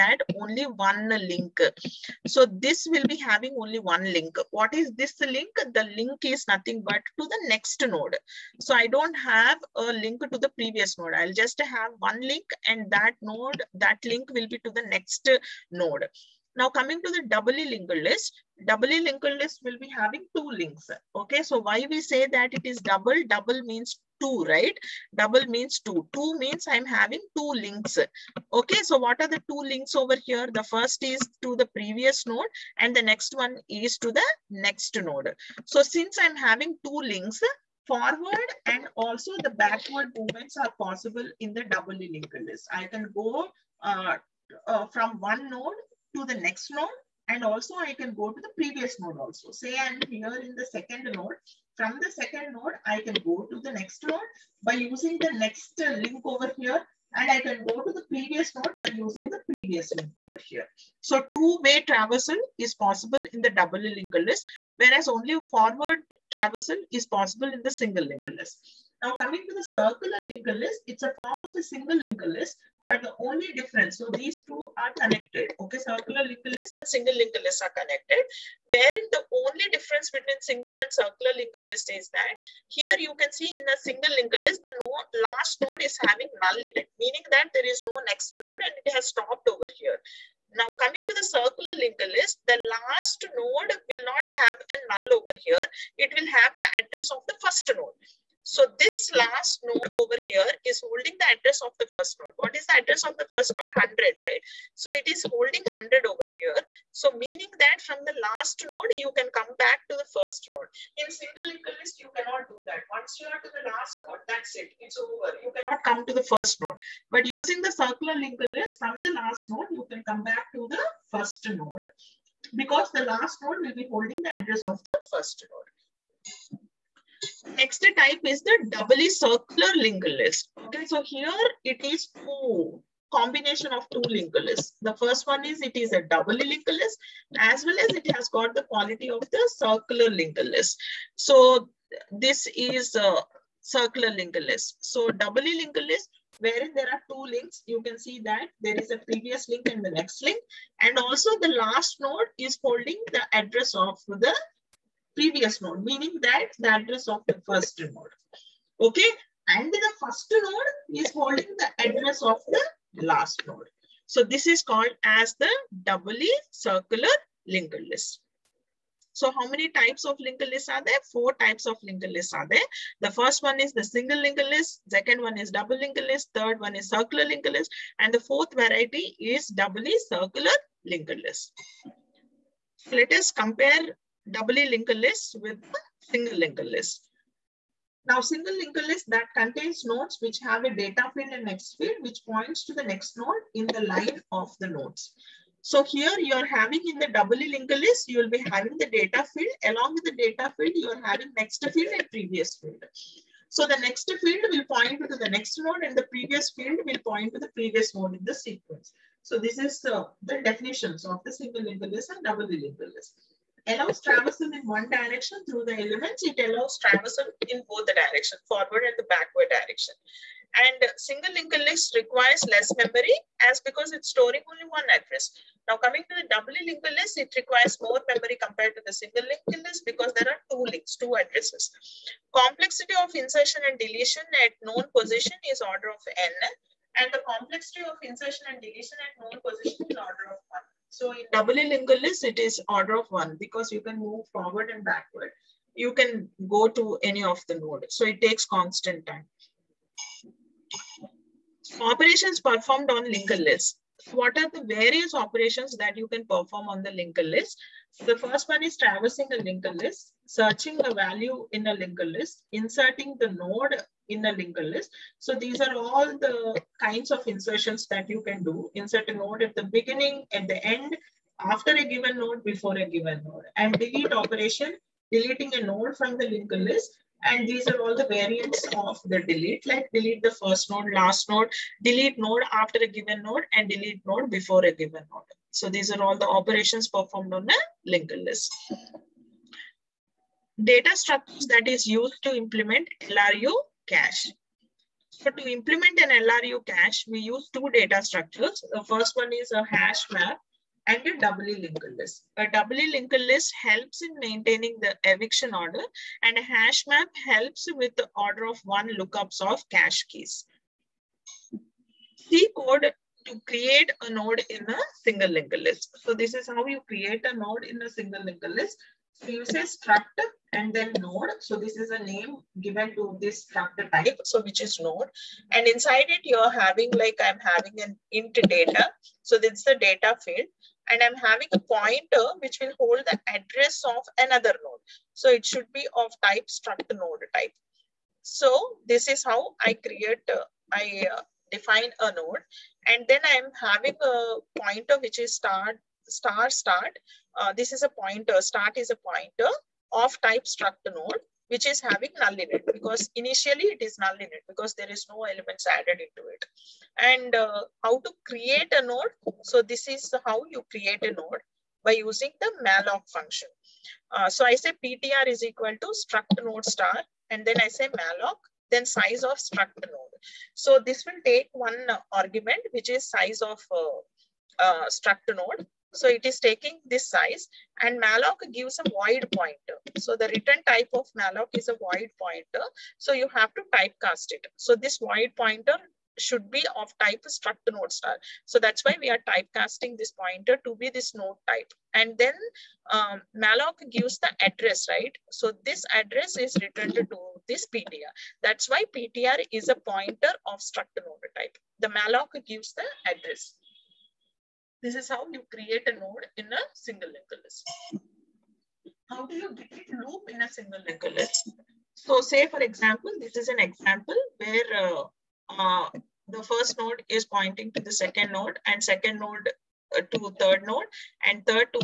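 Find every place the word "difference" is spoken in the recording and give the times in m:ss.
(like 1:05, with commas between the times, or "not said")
1:13, 1:19.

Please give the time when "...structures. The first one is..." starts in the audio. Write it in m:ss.
4:58.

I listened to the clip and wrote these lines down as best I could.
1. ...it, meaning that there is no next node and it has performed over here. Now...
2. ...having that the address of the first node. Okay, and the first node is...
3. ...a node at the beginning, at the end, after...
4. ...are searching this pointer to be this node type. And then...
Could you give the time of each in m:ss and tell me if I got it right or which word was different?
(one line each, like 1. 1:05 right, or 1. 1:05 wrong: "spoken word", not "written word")
1. 1:26 wrong: "stopped", not "performed"
2. 2:35 wrong: "meaning", not "having"
3. 4:29 right
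4. 6:29 wrong: "typecasting", not "searching".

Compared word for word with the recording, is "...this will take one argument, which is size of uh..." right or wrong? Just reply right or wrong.
right.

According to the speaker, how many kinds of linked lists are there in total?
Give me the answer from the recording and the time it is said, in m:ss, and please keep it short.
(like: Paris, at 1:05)
4, at 2:51.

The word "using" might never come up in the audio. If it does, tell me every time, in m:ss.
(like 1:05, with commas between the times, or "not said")
0:54, 0:58, 1:57, 6:01.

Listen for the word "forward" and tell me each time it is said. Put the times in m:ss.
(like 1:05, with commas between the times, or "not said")
0:37, 1:05, 3:38, 4:04.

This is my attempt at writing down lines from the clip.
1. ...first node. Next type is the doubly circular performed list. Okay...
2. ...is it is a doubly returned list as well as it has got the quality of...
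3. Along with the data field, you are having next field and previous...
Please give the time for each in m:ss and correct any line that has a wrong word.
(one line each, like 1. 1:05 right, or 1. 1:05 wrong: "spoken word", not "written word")
1. 2:05 wrong: "linked", not "performed"
2. 2:15 wrong: "linked", not "returned"
3. 3:19 right.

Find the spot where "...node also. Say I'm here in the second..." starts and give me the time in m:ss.
0:48.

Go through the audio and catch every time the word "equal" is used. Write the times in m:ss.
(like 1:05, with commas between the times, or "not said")
1:51, 6:05.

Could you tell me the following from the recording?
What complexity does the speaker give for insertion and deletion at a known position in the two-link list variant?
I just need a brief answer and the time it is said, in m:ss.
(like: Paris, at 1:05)
order of 1, at 3:59.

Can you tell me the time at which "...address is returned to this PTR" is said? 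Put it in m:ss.
6:35.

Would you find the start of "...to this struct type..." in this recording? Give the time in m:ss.
5:22.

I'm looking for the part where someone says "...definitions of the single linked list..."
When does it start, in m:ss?
3:30.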